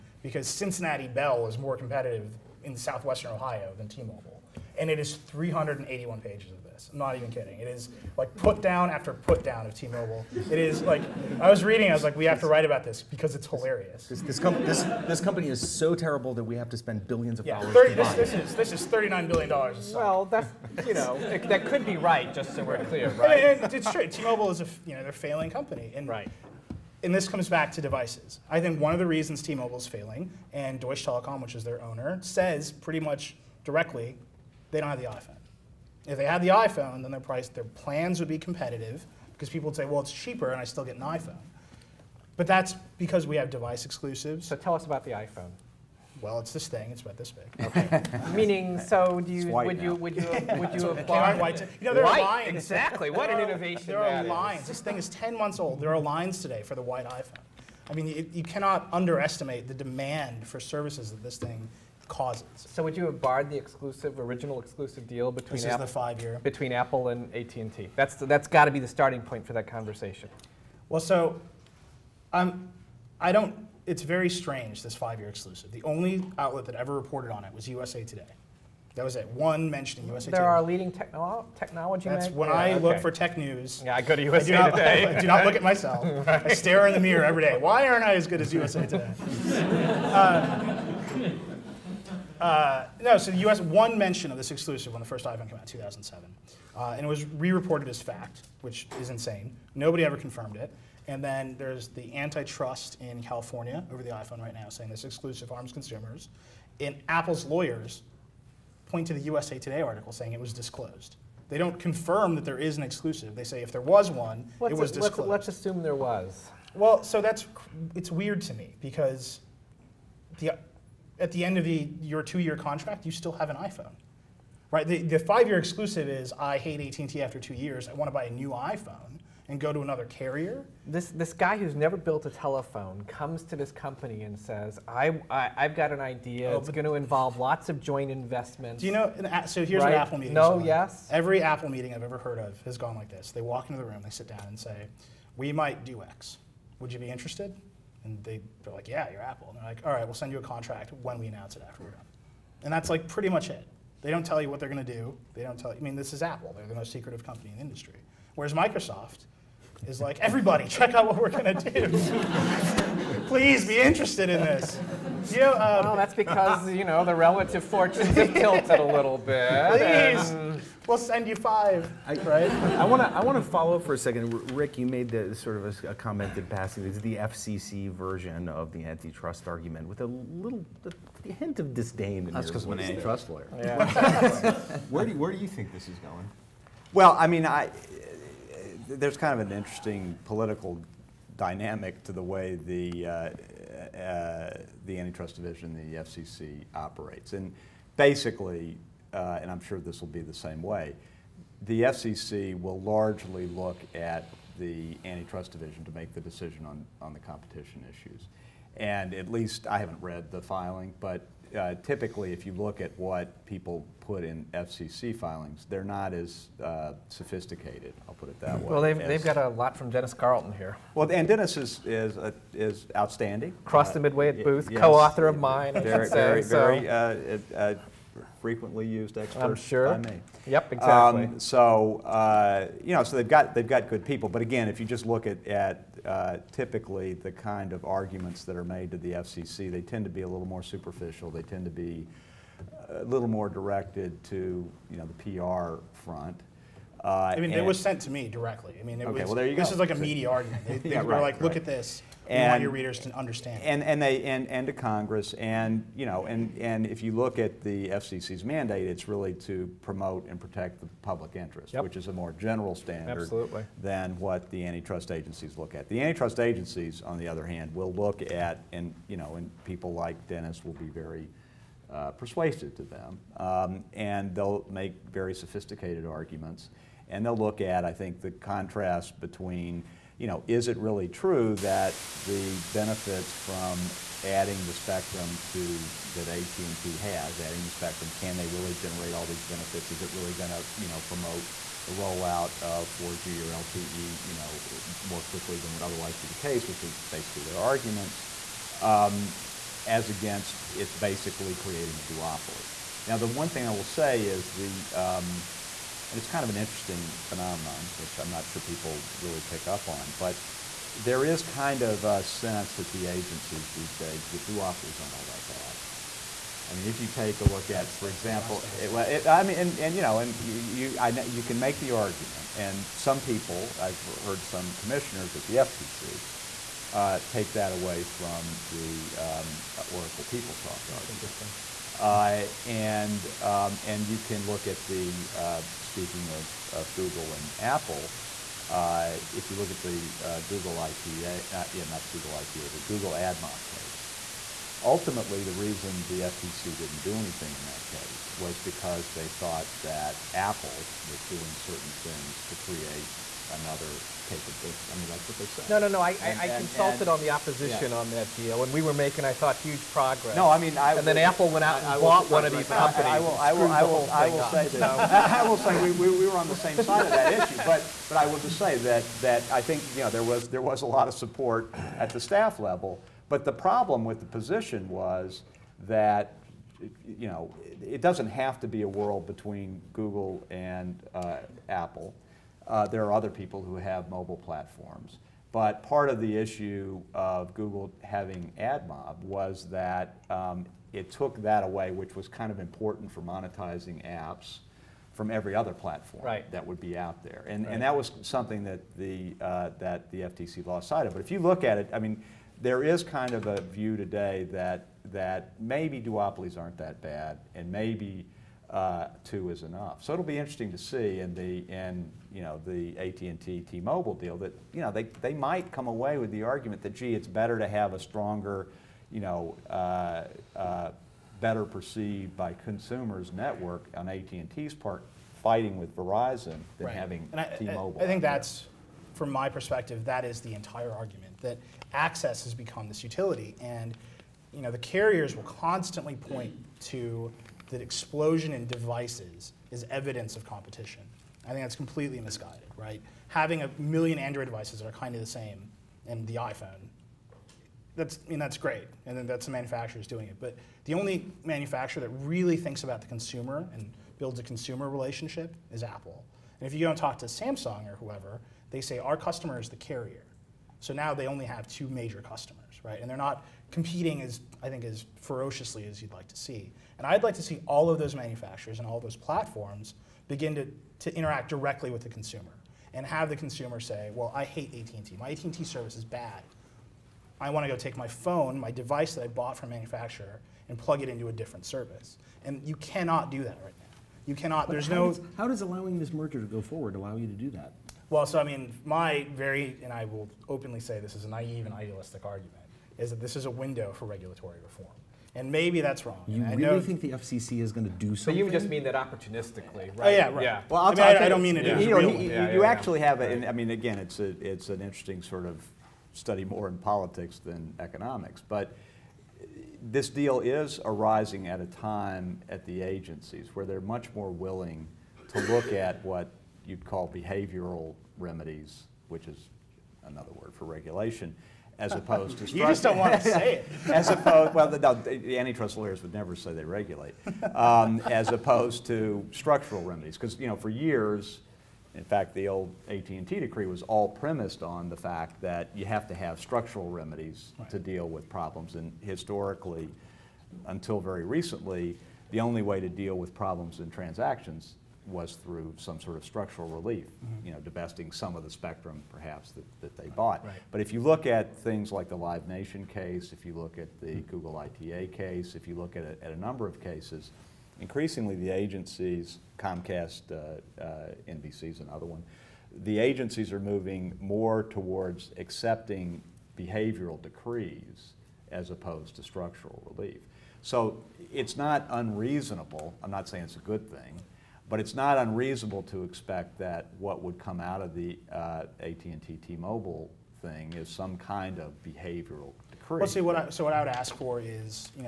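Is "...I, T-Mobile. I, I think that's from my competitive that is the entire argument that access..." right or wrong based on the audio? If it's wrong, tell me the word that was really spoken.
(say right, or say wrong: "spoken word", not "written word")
wrong: "perspective", not "competitive".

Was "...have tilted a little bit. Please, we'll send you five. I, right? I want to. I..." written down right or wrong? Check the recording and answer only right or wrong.
right.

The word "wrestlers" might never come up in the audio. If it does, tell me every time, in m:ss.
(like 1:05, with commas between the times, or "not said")
not said.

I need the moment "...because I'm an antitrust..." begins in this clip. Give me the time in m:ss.
3:02.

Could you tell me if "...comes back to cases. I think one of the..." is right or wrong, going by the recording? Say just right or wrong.
wrong.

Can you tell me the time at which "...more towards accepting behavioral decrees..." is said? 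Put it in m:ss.
9:24.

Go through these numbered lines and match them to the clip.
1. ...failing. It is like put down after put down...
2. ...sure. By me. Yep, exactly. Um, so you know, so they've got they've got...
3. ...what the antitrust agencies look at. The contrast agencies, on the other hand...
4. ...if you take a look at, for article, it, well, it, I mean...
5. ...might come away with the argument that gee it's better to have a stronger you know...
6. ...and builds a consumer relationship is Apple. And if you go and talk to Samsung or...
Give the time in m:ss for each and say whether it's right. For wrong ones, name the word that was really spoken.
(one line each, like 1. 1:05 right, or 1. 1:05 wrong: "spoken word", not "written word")
1. 0:07 wrong: "kidding", not "failing"
2. 3:49 right
3. 4:24 wrong: "antitrust", not "contrast"
4. 5:16 wrong: "example", not "article"
5. 6:55 right
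6. 7:33 right.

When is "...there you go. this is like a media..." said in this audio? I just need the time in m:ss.
4:09.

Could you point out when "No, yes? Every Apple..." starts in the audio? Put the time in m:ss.
2:20.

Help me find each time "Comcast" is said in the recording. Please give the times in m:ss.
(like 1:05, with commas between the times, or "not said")
9:19.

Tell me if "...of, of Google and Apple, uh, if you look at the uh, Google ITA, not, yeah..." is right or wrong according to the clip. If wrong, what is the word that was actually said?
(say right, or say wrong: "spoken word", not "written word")
right.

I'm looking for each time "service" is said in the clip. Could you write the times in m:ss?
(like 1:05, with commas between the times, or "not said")
1:00, 7:55, 8:01.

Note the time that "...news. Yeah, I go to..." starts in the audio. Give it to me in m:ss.
1:23.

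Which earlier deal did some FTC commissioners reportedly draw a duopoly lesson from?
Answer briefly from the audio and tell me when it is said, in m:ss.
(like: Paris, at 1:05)
Oracle PeopleSoft, at 5:29.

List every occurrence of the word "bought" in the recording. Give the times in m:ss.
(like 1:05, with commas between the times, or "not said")
6:01, 7:59, 9:10.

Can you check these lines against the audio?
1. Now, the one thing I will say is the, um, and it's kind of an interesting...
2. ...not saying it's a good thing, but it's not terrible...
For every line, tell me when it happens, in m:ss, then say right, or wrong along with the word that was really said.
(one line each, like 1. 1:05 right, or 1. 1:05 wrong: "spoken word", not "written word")
1. 5:03 right
2. 9:33 wrong: "unreasonable", not "terrible".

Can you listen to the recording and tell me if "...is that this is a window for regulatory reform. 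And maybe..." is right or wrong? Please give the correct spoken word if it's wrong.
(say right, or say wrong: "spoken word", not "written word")
right.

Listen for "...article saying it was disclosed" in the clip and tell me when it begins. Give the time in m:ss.
1:49.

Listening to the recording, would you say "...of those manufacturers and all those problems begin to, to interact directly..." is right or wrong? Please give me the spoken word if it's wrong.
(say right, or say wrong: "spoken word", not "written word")
wrong: "platforms", not "problems".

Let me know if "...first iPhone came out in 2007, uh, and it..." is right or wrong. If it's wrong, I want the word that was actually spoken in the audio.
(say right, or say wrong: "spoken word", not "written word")
right.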